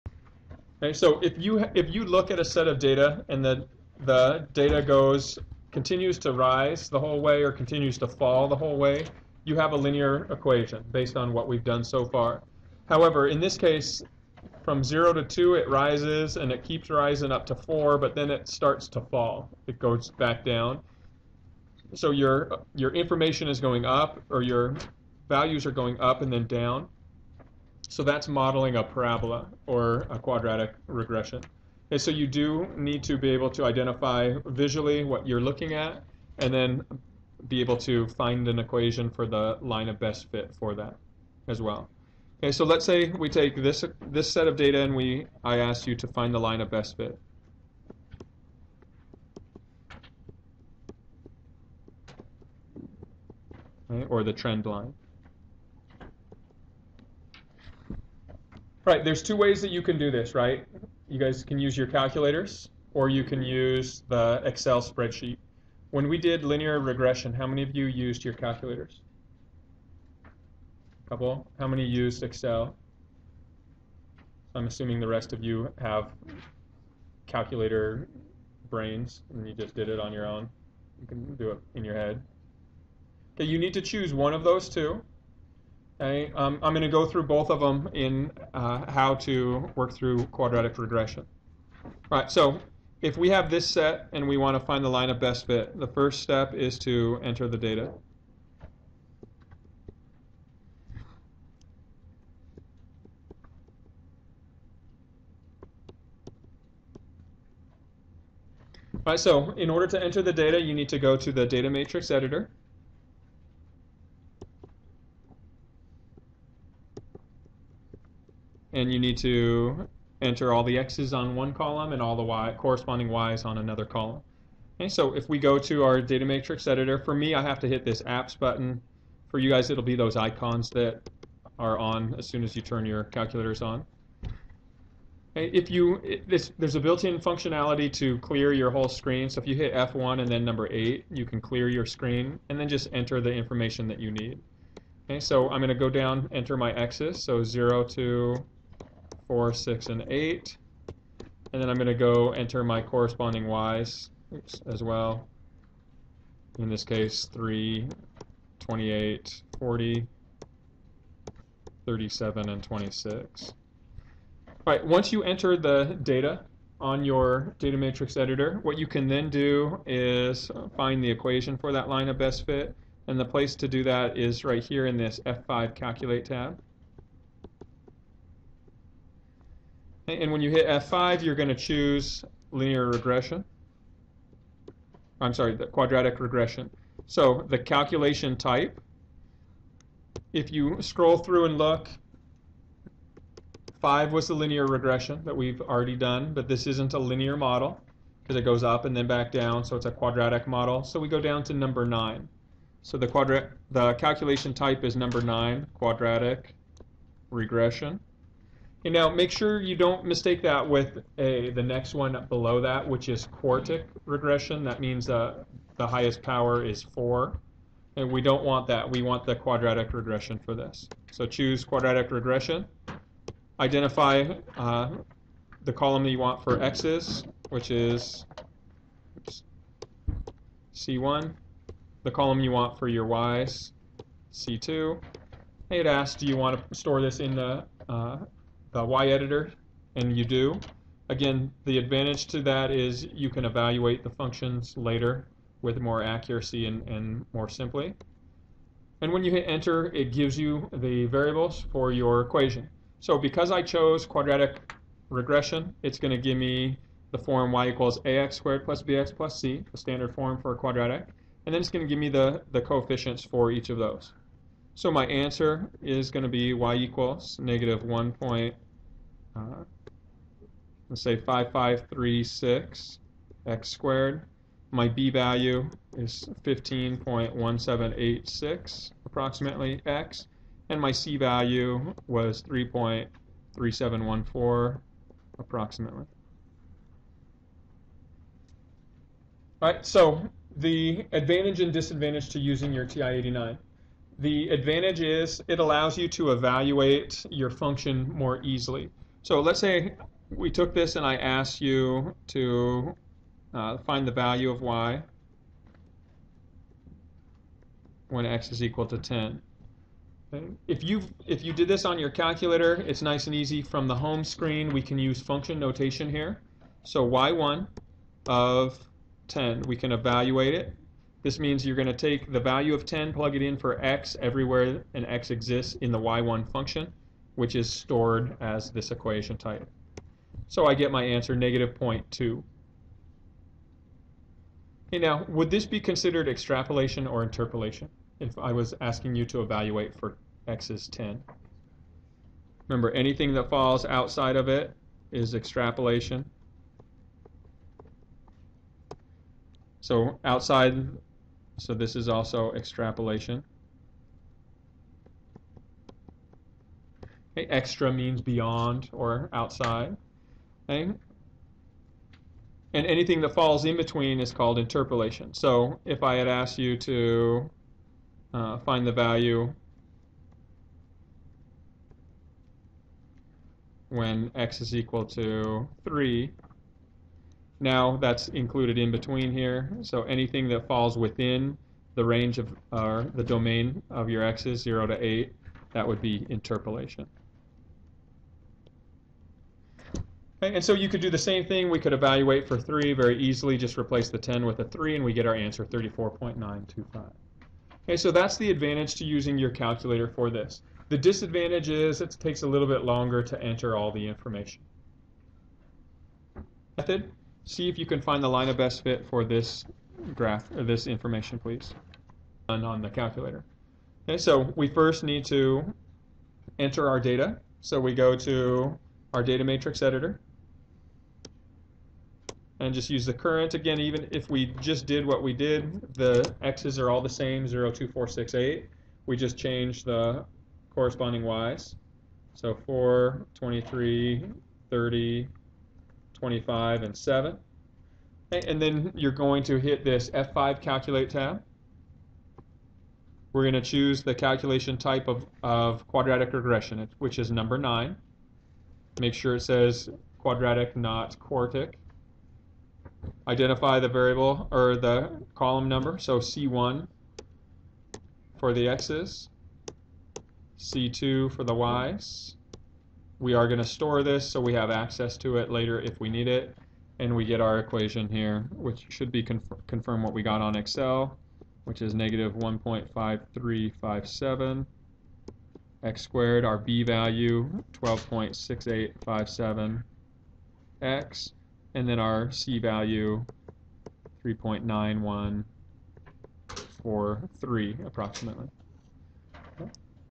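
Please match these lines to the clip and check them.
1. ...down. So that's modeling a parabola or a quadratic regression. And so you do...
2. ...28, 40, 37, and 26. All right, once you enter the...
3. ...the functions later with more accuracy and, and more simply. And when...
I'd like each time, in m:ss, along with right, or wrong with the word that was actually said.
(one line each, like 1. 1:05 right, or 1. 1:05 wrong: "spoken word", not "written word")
1. 0:26 right
2. 2:38 right
3. 4:04 right.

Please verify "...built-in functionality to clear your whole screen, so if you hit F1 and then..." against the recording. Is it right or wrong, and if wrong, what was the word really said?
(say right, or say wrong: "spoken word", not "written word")
right.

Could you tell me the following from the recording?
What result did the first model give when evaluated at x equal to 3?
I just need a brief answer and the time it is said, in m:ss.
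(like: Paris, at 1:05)
34.925, at 6:35.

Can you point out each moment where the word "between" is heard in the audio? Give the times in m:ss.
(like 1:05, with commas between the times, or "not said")
6:03, 6:18.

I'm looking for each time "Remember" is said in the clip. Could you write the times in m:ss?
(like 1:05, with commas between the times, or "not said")
5:42.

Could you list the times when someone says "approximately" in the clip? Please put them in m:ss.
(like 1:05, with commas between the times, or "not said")
4:39, 4:45, 8:07.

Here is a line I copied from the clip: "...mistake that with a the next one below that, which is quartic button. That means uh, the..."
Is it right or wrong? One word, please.
wrong.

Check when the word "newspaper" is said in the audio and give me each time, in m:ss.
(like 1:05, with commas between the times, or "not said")
not said.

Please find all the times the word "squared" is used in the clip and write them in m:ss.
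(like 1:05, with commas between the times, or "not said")
4:18, 4:33, 7:56.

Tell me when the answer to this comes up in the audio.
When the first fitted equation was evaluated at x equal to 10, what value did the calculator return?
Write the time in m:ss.
5:31.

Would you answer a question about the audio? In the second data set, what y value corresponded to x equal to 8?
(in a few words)
7.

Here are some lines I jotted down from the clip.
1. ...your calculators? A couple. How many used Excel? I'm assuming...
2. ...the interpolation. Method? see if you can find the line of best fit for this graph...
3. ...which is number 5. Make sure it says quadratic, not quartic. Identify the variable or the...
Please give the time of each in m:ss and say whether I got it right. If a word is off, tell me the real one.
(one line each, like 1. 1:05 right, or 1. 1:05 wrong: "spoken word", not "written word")
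1. 1:08 right
2. 6:43 wrong: "information", not "interpolation"
3. 7:26 wrong: "9", not "5".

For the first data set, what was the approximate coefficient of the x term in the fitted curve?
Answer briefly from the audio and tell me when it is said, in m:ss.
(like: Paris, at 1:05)
15.1786, at 4:36.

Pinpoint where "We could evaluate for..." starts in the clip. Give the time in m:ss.
6:31.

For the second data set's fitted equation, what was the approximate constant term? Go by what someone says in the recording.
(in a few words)
3.9143.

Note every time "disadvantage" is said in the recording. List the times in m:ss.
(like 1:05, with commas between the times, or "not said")
4:51, 6:40.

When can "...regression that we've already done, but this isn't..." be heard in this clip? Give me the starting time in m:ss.
3:14.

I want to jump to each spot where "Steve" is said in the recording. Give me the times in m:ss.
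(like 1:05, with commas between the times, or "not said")
not said.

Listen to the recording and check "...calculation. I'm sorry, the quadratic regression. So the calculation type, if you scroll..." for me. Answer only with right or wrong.
wrong.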